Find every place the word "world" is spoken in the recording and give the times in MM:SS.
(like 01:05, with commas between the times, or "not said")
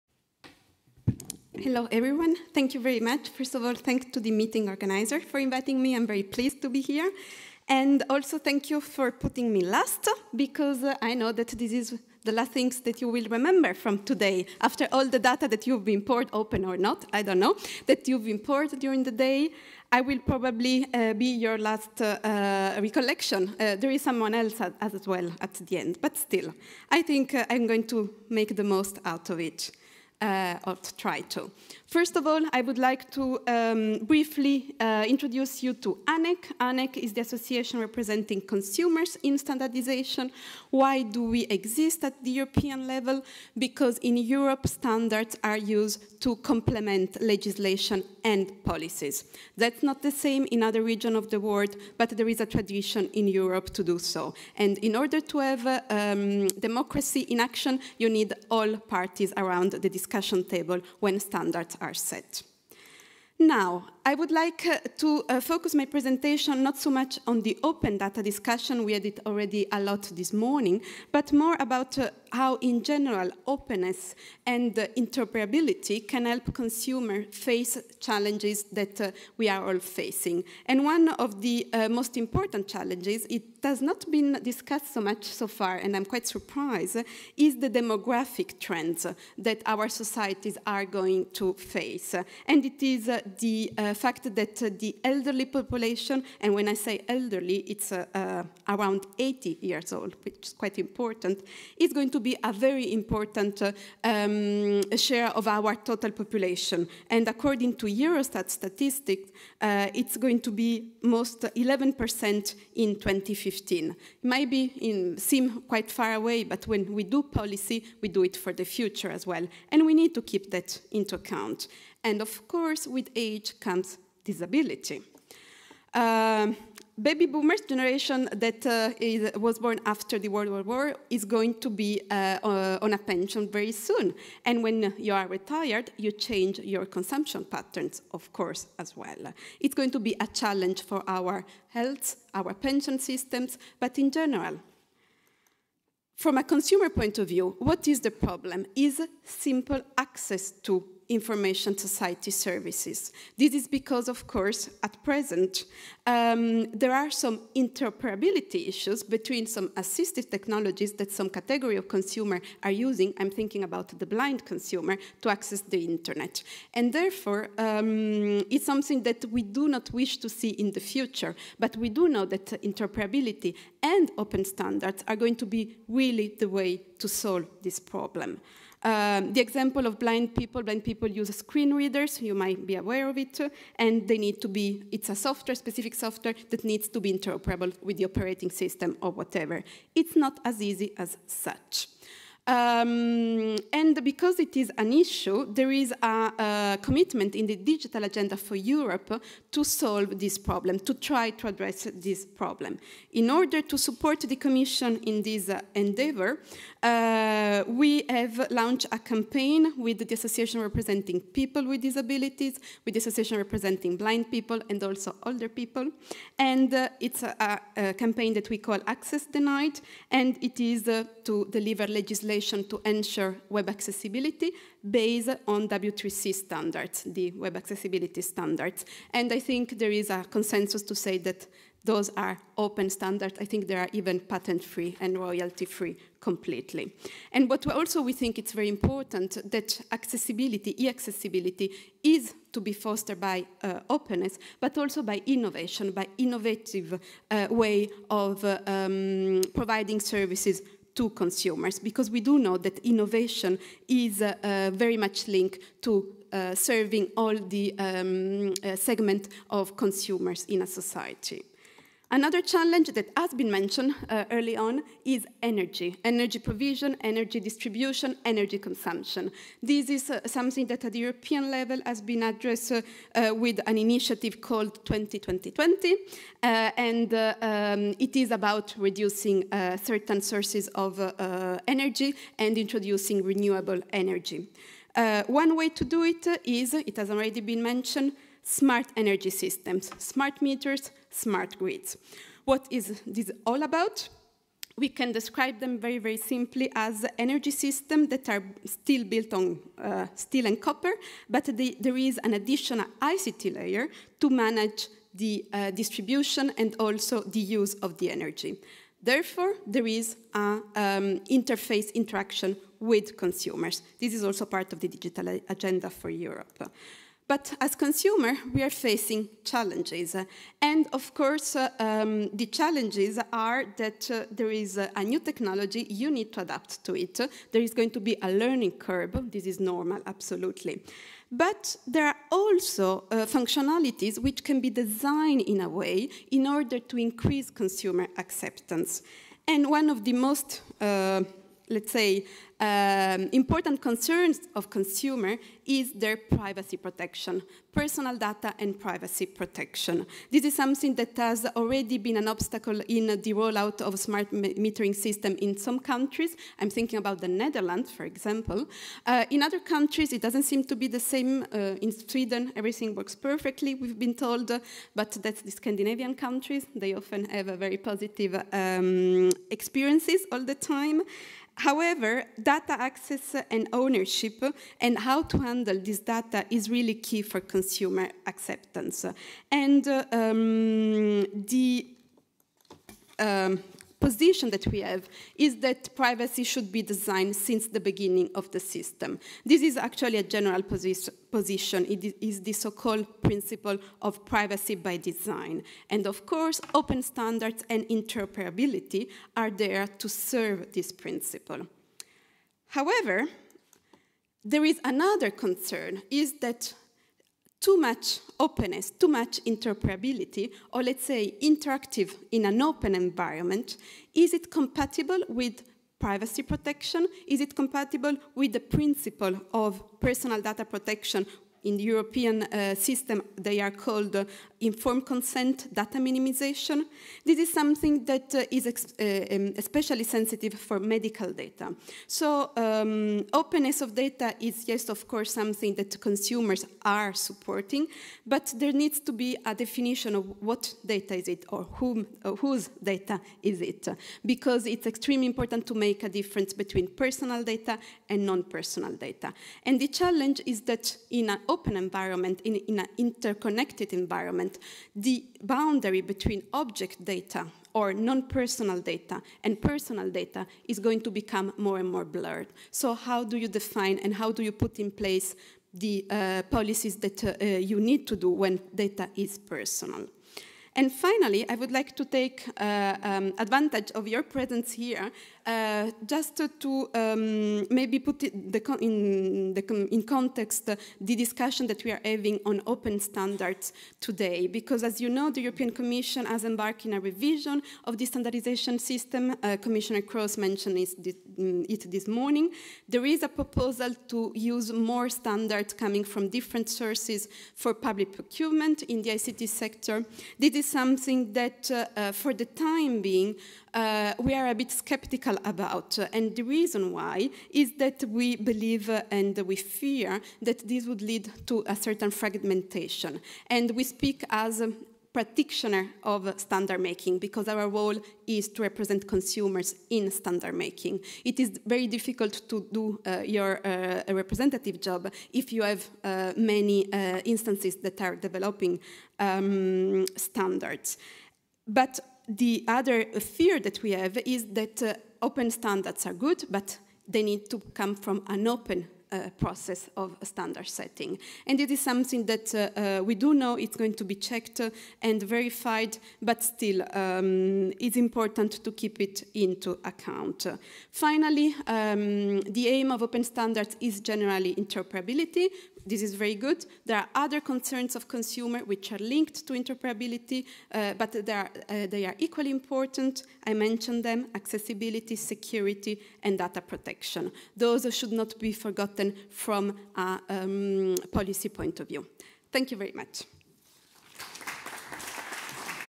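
00:51, 02:10.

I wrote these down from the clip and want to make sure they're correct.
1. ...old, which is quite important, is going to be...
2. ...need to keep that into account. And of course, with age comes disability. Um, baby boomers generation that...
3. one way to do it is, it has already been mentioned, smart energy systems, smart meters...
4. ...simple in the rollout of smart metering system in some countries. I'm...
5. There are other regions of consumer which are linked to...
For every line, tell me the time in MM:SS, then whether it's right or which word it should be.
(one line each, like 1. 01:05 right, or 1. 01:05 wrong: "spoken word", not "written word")
1. 01:39 right
2. 01:59 right
3. 04:45 right
4. 05:52 wrong: "obstacle", not "simple"
5. 09:16 wrong: "concerns", not "regions".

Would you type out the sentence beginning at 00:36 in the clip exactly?
ANEC is the association representing consumers in standardization.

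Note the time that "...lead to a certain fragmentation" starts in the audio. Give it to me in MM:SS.
08:31.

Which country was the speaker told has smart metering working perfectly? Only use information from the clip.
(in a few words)
Sweden.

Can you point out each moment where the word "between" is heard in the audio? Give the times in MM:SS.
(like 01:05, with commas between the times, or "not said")
02:39, 07:26, 07:36.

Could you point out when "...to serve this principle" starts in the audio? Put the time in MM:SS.
06:40.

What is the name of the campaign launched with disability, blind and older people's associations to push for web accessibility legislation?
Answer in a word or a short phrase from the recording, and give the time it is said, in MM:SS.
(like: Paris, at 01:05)
Access Denied, at 03:38.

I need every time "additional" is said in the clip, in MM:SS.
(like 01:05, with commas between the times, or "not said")
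05:02.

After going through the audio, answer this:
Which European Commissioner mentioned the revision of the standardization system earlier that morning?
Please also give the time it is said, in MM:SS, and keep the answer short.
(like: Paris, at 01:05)
Commissioner Kroes, at 08:09.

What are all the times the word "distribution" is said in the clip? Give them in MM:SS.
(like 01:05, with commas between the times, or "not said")
04:27, 05:05.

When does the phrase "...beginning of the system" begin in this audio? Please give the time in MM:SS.
06:27.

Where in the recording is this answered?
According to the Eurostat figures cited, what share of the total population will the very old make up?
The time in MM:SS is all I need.
01:51.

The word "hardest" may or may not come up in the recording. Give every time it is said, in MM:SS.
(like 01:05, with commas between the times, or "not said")
not said.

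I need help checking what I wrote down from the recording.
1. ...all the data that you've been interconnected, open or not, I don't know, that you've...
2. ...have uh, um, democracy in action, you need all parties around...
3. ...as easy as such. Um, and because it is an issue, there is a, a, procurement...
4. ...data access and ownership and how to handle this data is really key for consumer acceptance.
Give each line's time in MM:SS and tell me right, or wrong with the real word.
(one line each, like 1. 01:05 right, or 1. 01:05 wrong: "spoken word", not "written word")
1. 00:14 wrong: "poured", not "interconnected"
2. 00:55 right
3. 03:10 wrong: "commitment", not "procurement"
4. 06:12 right.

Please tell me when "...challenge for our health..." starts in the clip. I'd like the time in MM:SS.
02:20.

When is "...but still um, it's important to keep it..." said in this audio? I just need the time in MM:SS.
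09:06.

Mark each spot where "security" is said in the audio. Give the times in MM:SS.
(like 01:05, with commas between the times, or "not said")
09:25.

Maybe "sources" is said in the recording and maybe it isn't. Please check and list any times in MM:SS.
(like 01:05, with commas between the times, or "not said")
04:40, 08:16.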